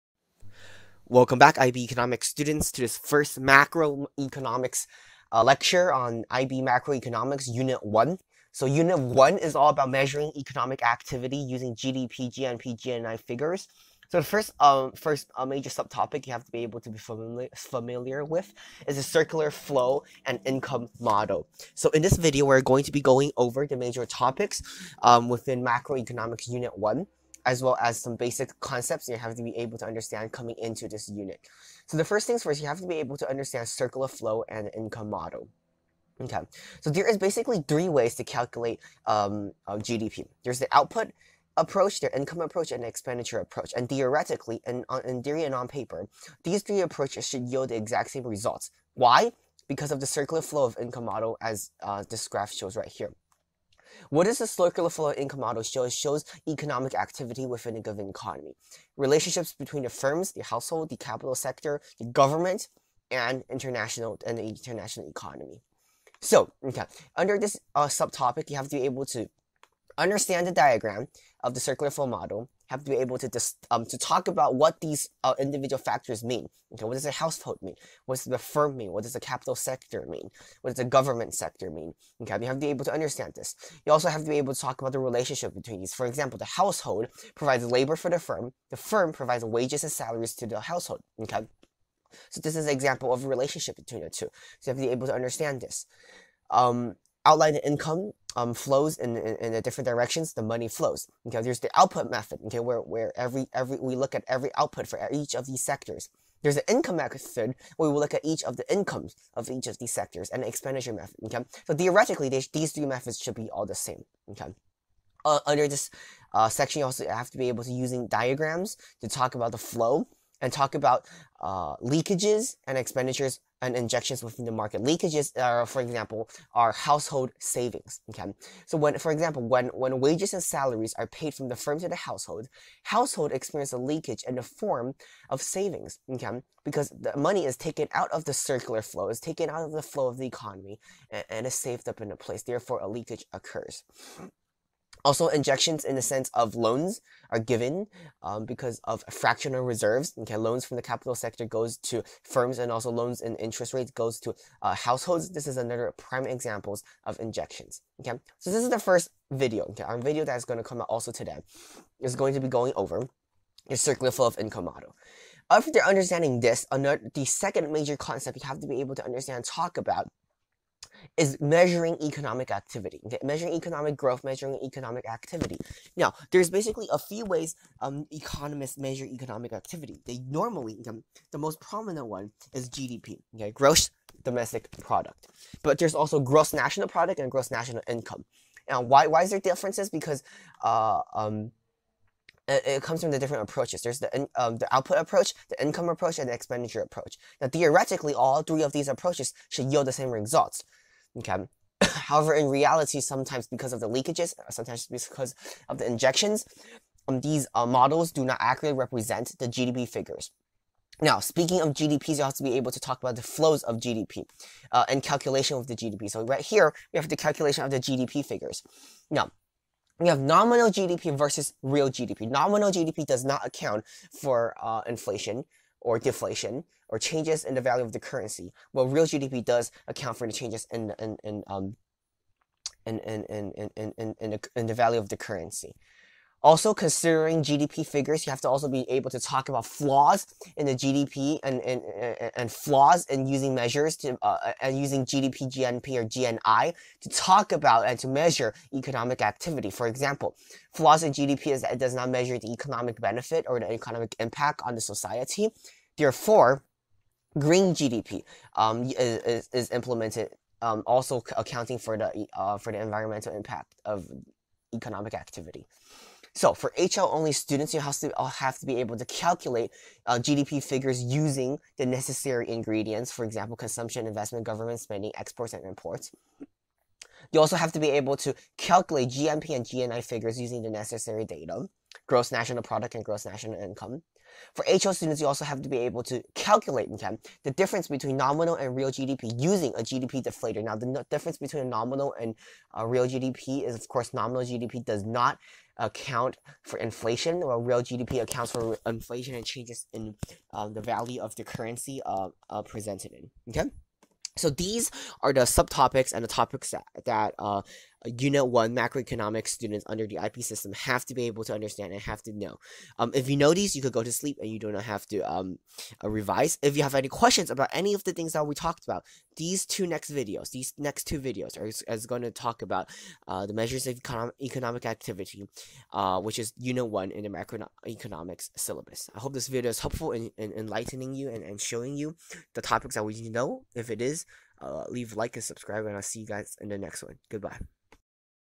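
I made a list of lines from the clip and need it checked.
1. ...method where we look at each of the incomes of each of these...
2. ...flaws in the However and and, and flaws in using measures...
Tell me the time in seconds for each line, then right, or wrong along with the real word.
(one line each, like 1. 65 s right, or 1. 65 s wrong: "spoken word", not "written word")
1. 106 s right
2. 239 s wrong: "GDP", not "However".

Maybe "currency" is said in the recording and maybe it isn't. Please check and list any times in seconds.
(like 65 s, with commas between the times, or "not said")
227 s, 235 s, 301 s.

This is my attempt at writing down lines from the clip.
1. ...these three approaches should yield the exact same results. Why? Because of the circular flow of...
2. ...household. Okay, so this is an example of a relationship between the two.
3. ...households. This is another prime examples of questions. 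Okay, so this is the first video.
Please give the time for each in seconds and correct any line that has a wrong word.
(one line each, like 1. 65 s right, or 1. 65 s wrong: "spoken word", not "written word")
1. 46 s right
2. 90 s right
3. 154 s wrong: "injections", not "questions".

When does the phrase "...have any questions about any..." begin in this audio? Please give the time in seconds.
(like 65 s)
316 s.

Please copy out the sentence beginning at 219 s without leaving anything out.
Now, we have nominal GDP versus real GDP.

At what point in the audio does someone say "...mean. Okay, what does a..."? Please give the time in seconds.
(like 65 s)
76 s.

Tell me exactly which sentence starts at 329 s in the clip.
I hope this video is helpful in, in enlightening you and, and showing you the topics that we need to know.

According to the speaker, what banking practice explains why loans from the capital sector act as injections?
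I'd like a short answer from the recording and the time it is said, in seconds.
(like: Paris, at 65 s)
fractional reserves, at 149 s.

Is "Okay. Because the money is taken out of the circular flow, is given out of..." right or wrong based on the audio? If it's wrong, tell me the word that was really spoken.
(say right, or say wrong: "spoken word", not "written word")
wrong: "taken", not "given".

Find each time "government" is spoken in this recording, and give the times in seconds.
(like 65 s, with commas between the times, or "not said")
62 s, 80 s, 274 s.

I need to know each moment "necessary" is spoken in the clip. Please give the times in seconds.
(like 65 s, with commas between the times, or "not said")
271 s, 280 s.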